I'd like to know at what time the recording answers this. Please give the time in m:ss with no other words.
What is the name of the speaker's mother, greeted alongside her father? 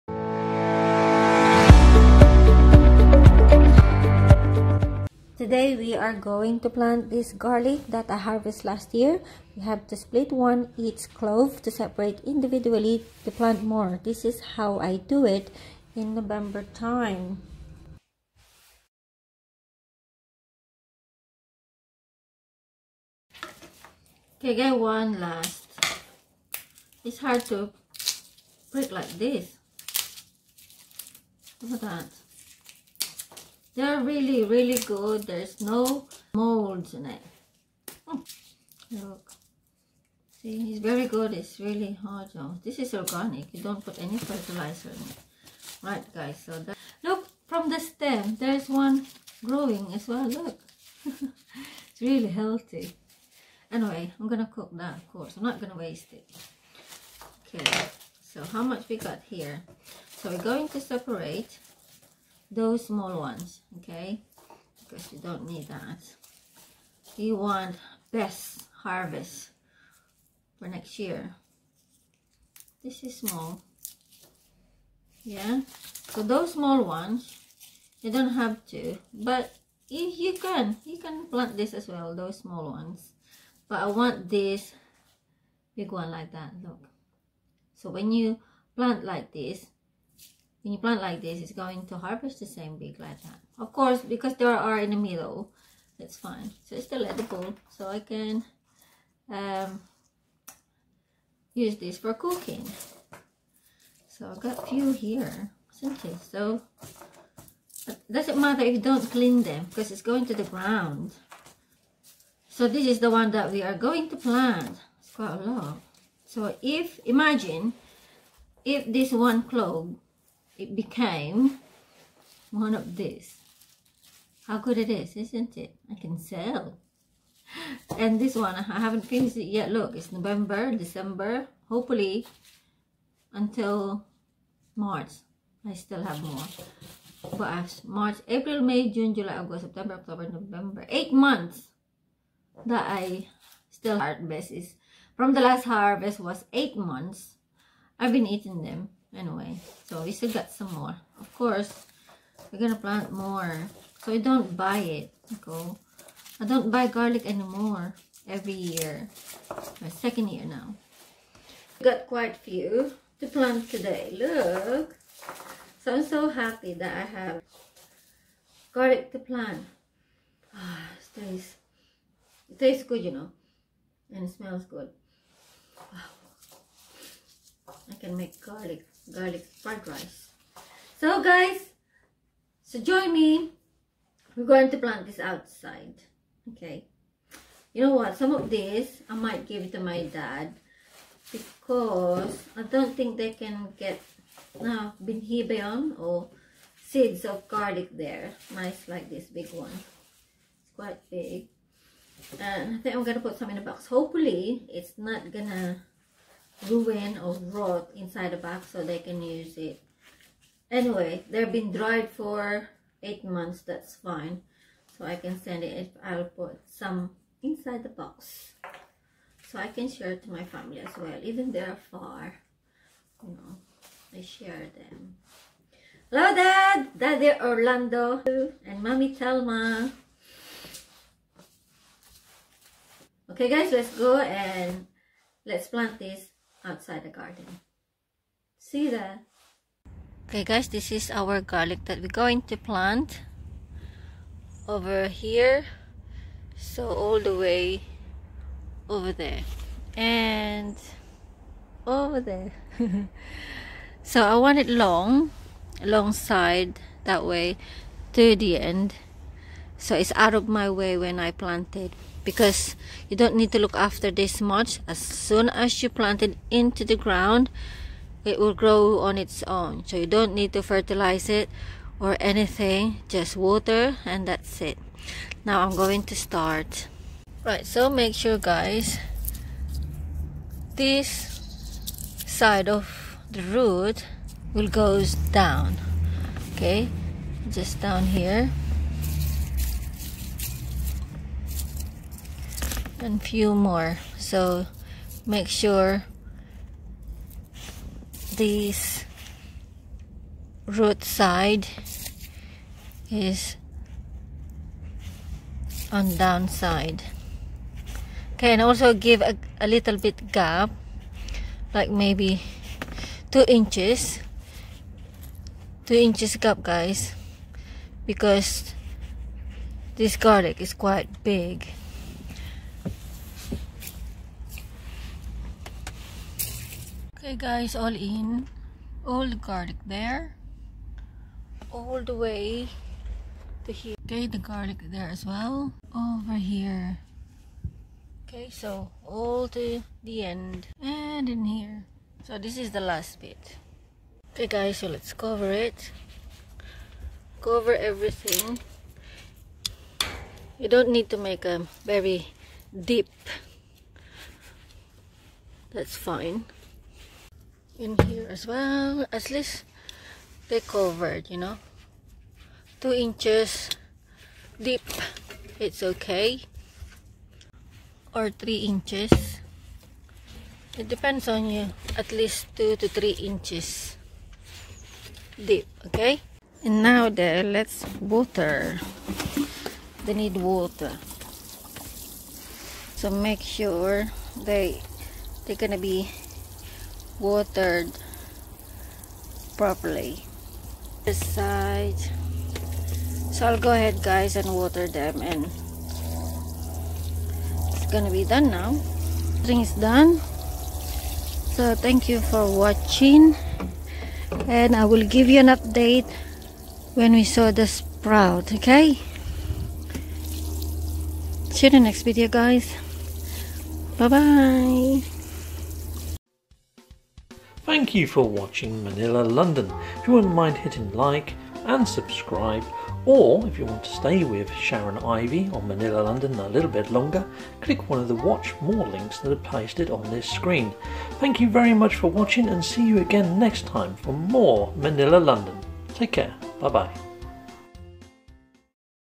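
3:49.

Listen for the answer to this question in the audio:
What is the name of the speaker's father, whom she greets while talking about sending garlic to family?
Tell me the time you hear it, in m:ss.
3:47.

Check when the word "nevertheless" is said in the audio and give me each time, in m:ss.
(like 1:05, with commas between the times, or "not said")
not said.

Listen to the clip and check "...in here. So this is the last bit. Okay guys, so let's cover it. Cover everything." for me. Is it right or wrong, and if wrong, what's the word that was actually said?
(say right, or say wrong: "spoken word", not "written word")
right.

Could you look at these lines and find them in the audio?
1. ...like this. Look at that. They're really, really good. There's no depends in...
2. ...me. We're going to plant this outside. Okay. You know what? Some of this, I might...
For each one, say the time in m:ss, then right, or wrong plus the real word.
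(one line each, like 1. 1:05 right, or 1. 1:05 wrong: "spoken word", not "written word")
1. 0:28 wrong: "molds", not "depends"
2. 3:03 right.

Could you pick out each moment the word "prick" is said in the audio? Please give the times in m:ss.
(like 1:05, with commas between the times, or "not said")
0:28.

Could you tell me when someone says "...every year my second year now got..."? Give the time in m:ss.
2:38.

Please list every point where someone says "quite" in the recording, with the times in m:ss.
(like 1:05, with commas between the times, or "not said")
1:55, 2:42, 3:20, 5:20.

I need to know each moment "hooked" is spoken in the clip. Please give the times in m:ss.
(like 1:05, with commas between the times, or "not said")
not said.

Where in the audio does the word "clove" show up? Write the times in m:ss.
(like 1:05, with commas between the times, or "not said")
0:11, 1:59.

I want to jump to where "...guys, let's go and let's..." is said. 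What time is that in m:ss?
3:53.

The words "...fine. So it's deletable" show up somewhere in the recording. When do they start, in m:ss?
1:36.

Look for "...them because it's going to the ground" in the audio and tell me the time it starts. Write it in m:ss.
1:49.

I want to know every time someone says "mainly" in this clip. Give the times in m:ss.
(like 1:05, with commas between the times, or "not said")
not said.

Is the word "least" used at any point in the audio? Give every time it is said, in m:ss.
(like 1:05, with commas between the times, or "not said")
5:59, 6:12.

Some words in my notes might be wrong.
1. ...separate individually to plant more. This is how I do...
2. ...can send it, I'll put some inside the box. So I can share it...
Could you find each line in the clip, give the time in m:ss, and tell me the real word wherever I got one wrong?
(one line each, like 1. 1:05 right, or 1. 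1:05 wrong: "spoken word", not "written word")
1. 0:11 right
2. 3:35 right.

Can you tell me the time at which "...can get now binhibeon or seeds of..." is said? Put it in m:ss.
3:13.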